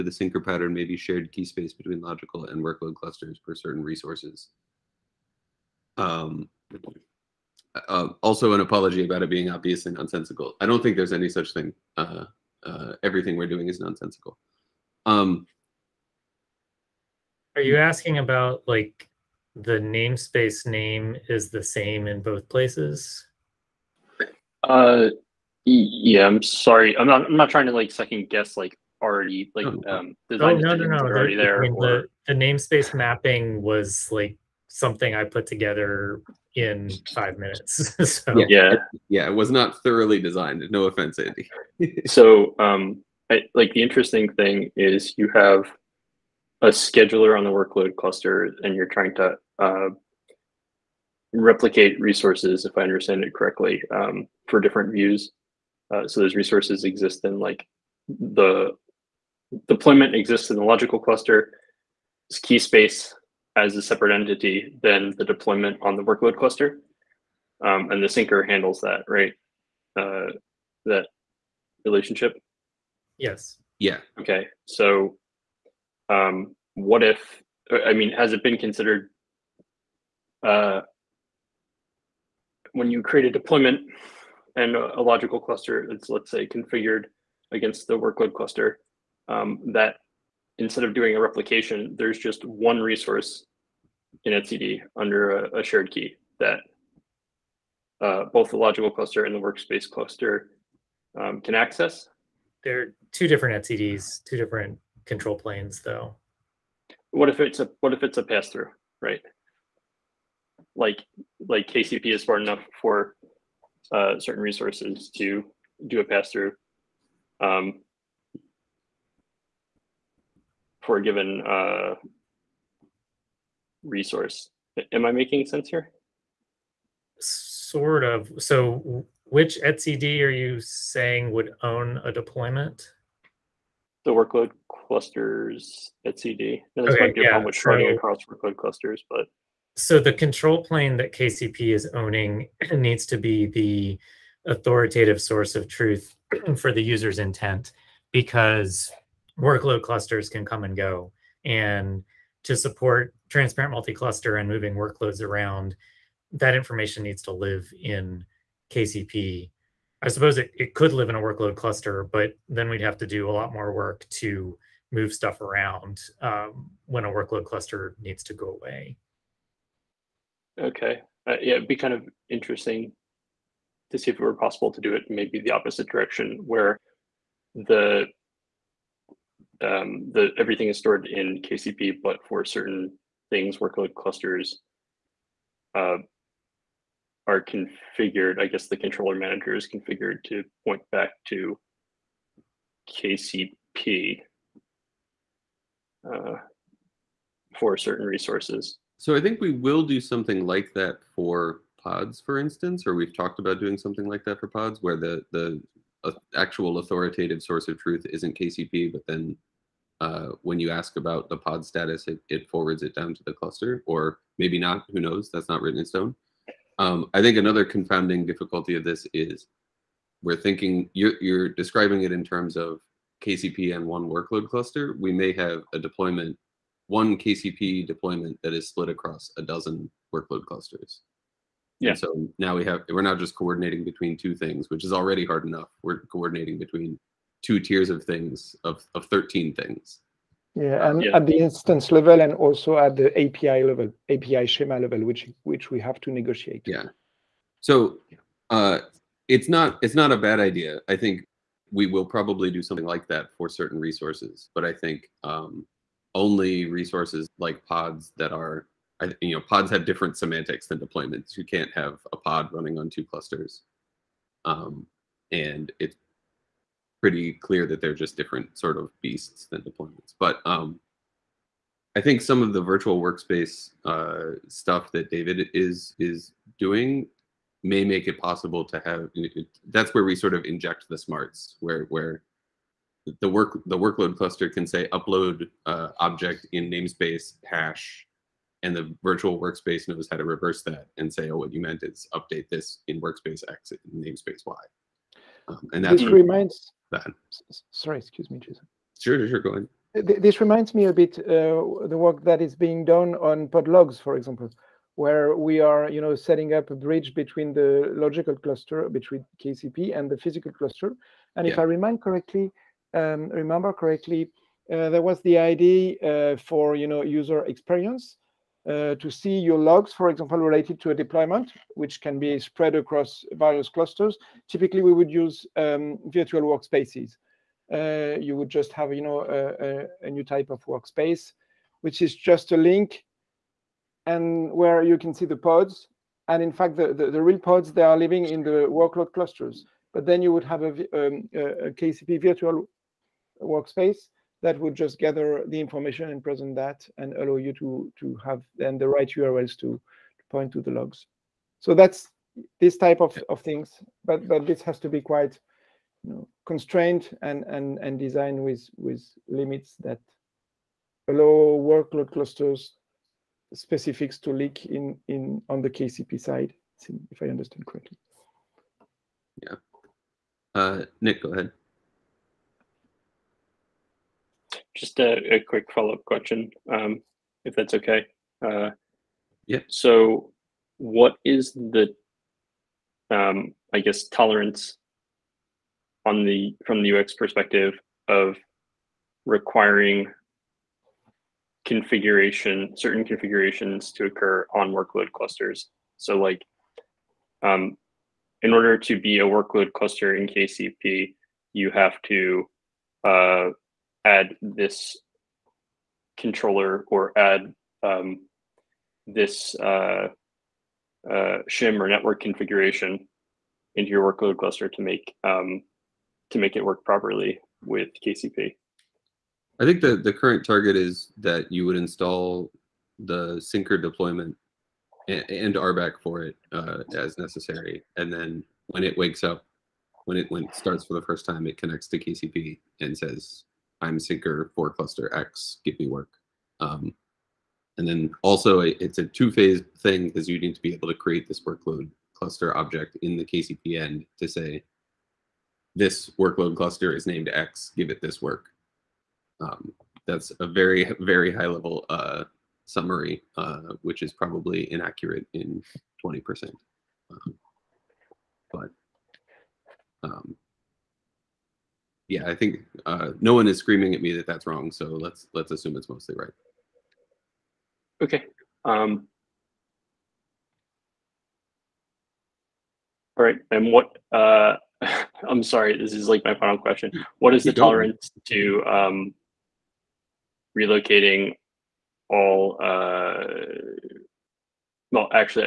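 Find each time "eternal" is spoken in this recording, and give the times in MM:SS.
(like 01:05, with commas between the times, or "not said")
not said.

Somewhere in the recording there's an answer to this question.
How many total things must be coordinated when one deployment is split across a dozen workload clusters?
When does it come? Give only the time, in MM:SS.
03:59.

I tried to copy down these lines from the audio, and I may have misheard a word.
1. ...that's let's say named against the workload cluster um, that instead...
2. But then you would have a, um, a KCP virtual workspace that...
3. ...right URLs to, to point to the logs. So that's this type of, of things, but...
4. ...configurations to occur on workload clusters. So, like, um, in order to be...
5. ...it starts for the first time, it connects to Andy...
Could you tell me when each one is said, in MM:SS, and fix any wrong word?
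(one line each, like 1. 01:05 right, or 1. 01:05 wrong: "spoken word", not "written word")
1. 01:25 wrong: "configured", not "named"
2. 05:39 right
3. 05:48 right
4. 06:33 right
5. 07:10 wrong: "KCP", not "Andy".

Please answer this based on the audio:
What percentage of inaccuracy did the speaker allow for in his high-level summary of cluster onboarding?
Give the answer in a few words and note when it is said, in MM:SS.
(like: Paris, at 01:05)
20%, at 07:36.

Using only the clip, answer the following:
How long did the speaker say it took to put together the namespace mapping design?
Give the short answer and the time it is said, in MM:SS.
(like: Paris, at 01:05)
5 minutes, at 00:37.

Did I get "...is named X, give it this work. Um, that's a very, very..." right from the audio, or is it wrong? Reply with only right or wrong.
right.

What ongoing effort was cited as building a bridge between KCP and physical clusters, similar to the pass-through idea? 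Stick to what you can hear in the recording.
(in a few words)
podlogs.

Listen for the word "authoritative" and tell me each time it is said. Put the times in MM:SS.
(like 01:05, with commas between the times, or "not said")
02:24, 03:26.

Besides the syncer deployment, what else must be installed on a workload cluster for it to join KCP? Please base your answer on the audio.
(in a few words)
RBAC.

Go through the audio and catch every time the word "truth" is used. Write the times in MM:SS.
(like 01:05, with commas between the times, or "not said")
02:25, 03:27.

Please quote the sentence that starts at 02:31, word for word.
And to support transparent multi-cluster and moving workloads around, that information needs to live in KCP.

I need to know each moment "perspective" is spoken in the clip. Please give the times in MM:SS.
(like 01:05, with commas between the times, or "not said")
06:27.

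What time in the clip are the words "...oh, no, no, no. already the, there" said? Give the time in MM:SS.
00:30.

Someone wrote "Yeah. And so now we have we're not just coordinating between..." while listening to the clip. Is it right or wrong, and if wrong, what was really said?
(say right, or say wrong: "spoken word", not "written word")
right.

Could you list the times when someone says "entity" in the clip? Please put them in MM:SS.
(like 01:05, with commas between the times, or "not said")
01:04.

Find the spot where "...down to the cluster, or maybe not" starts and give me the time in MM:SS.
03:32.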